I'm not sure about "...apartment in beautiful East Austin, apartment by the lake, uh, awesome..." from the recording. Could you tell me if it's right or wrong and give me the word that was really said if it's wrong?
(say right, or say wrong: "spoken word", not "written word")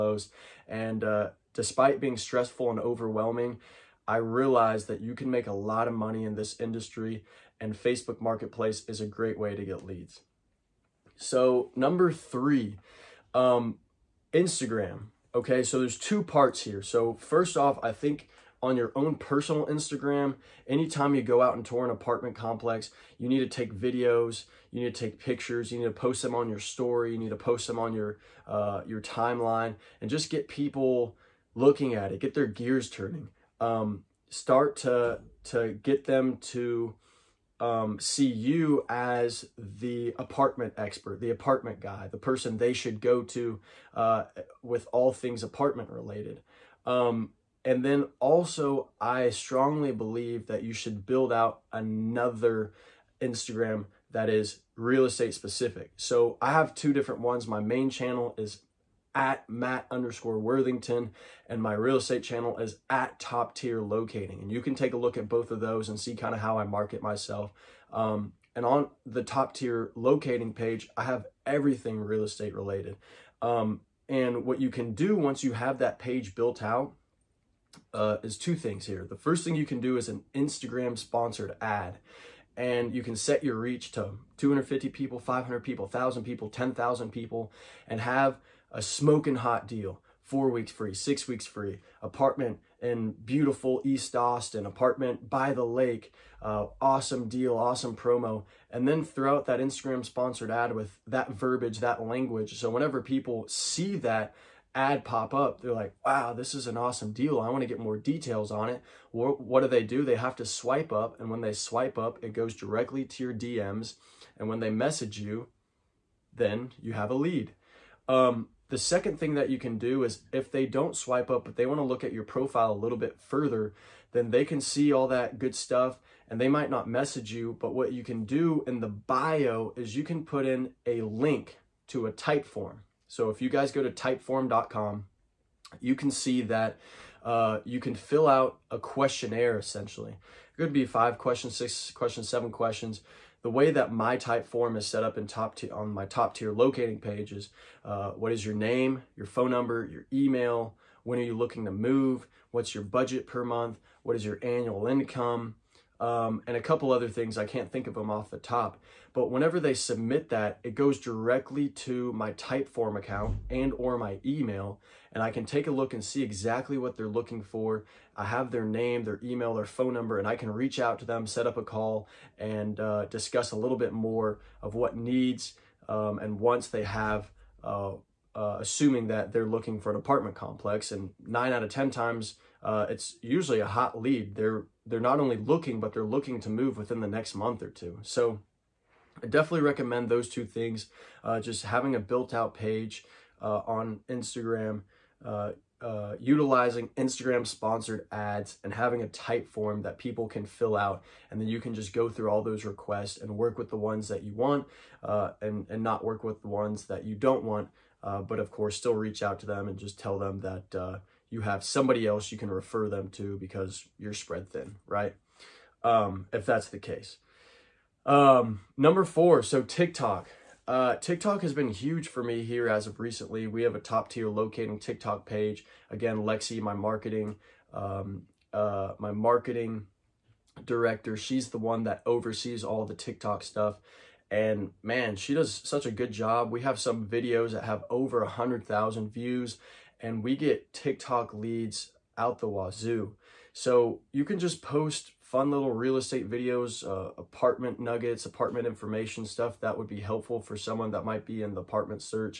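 right.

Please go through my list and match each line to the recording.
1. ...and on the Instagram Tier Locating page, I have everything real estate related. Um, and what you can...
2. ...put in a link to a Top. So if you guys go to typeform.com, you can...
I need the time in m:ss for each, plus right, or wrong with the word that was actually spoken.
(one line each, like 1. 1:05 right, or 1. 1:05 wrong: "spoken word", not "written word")
1. 1:08 wrong: "Top", not "Instagram"
2. 2:10 wrong: "Typeform", not "Top".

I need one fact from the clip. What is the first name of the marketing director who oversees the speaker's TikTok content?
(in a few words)
Lexi.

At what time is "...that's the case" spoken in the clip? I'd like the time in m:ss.
3:36.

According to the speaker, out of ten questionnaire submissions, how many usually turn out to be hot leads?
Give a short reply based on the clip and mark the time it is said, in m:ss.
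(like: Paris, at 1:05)
9, at 3:01.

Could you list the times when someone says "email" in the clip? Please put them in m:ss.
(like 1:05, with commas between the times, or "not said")
2:30, 2:44, 2:49.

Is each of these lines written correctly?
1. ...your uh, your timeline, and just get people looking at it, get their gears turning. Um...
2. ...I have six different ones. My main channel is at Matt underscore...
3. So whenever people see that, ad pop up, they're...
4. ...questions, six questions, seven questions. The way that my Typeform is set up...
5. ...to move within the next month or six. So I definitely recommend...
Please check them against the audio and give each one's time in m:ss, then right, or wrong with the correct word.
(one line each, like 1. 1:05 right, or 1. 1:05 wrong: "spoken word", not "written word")
1. 0:27 right
2. 0:56 wrong: "two", not "six"
3. 1:42 right
4. 2:21 right
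5. 3:06 wrong: "two", not "six".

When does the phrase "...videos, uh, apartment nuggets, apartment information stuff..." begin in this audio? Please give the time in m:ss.
4:06.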